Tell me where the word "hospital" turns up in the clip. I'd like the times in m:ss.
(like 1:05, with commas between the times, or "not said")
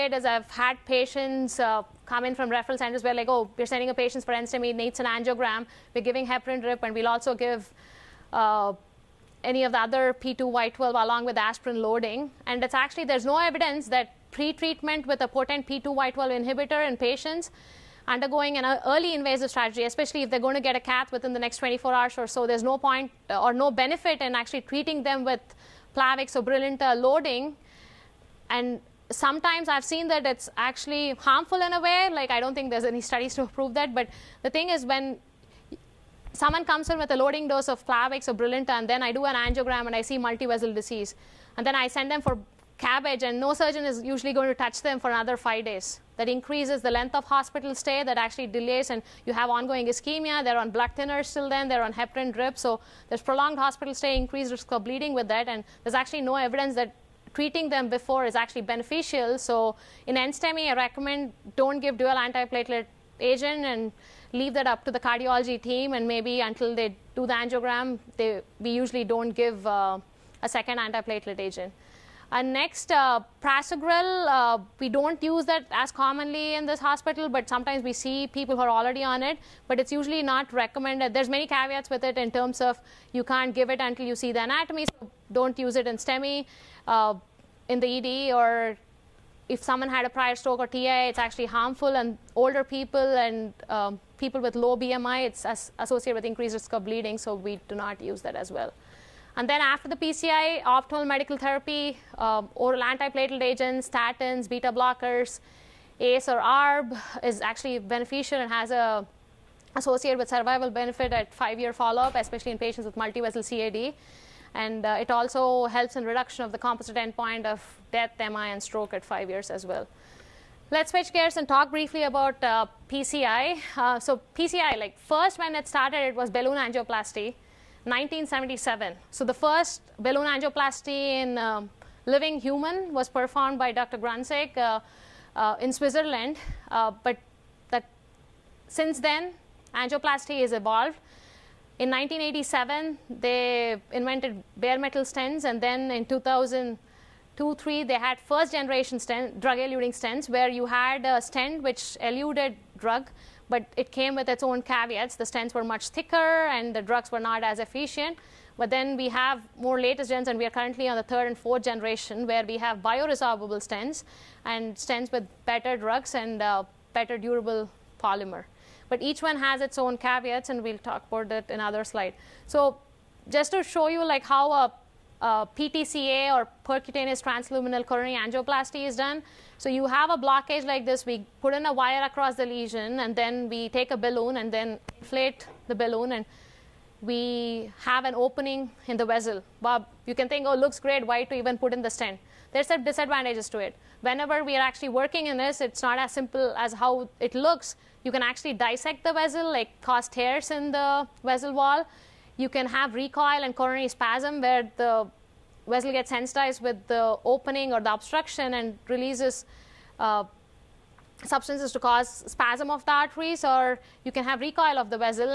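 0:47, 0:53, 1:16.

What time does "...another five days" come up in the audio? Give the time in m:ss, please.
0:45.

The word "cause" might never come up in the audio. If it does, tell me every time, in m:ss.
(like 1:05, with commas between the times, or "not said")
3:19, 3:31.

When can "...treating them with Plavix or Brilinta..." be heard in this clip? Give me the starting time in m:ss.
0:24.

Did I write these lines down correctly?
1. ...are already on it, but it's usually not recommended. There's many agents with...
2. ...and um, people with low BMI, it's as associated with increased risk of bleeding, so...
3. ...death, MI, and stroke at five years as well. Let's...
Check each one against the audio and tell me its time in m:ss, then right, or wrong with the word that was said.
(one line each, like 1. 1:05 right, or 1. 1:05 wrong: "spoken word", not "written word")
1. 1:18 wrong: "caveats", not "agents"
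2. 1:33 right
3. 1:57 right.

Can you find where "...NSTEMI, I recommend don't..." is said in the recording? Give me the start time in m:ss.
1:00.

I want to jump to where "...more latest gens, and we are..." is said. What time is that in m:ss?
2:39.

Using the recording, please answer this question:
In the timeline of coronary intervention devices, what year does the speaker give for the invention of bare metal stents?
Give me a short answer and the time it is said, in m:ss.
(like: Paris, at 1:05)
1987, at 2:21.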